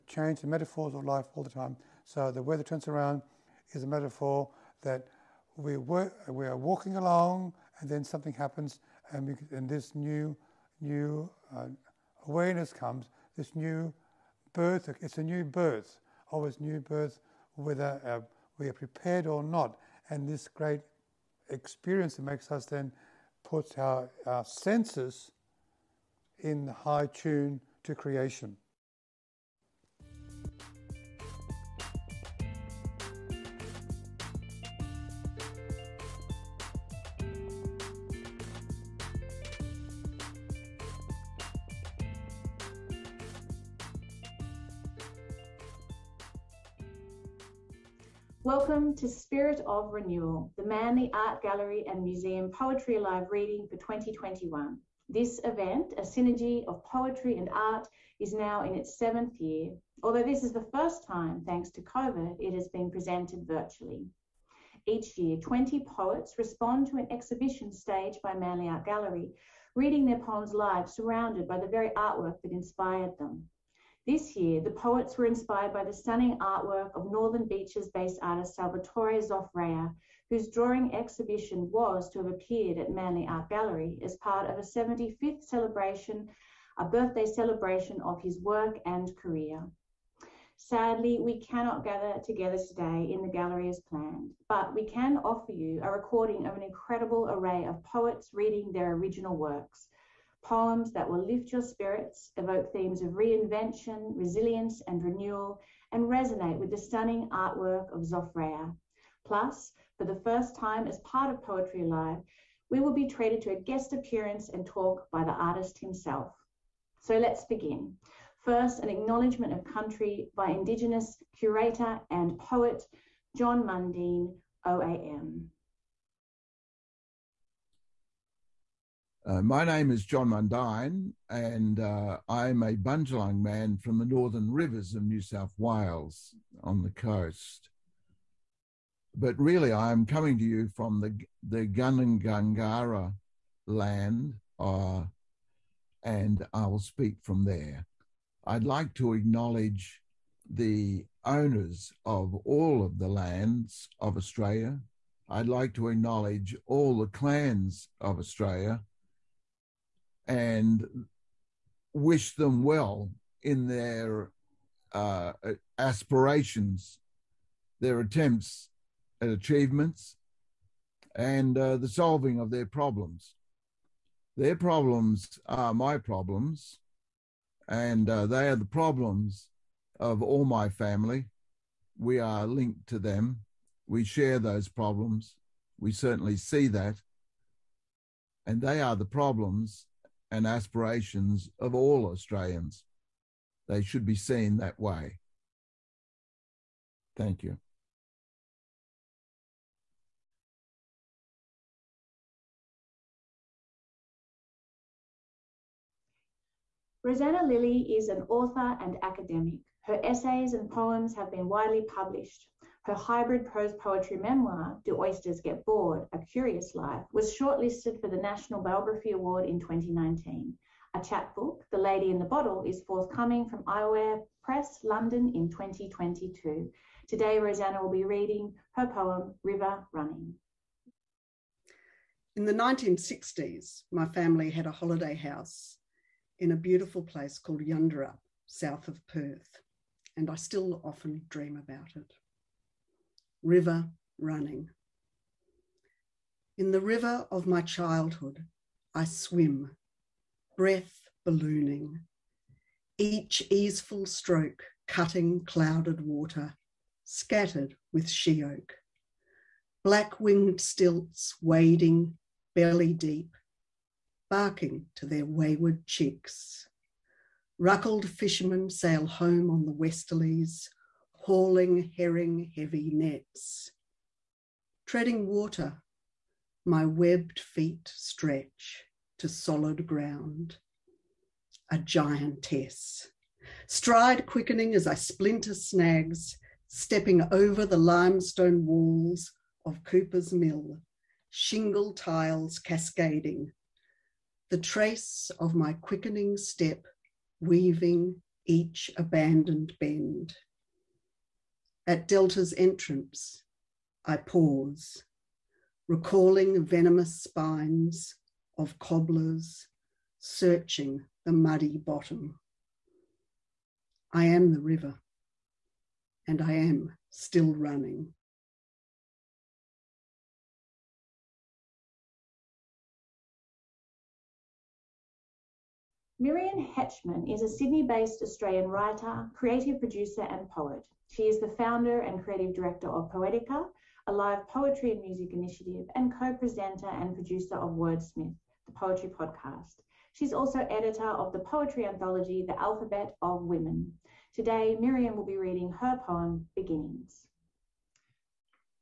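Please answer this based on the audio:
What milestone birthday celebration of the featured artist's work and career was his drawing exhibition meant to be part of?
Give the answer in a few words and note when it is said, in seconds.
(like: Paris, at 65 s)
75th, at 84 s.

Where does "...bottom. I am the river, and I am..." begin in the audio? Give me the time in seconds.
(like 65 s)
311 s.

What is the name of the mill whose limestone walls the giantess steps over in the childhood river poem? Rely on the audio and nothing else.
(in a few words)
Cooper's Mill.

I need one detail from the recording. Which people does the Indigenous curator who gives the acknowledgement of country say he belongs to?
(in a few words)
Bundjalung.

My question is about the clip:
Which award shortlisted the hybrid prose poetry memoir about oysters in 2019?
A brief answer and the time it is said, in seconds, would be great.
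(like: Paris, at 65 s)
National Biography Award, at 218 s.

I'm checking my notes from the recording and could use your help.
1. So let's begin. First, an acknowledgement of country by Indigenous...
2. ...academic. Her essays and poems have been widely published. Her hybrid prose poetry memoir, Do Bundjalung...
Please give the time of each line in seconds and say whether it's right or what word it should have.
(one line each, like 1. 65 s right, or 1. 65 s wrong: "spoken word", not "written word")
1. 116 s right
2. 209 s wrong: "Oysters", not "Bundjalung".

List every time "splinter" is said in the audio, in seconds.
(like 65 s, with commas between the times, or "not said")
284 s.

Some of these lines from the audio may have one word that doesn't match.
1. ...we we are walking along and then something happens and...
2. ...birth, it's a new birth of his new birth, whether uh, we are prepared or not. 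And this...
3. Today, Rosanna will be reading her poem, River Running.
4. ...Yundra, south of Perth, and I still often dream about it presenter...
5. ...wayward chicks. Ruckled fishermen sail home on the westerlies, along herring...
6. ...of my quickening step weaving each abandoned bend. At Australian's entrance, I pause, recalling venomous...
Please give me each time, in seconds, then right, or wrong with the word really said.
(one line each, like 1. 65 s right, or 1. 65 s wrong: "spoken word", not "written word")
1. 5 s right
2. 14 s right
3. 227 s right
4. 237 s wrong: "river", not "presenter"
5. 265 s wrong: "hauling", not "along"
6. 295 s wrong: "Delta", not "Australian".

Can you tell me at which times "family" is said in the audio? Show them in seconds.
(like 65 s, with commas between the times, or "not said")
180 s, 234 s.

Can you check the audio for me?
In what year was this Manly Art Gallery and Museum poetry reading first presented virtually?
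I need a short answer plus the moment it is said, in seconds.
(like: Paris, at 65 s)
2021, at 53 s.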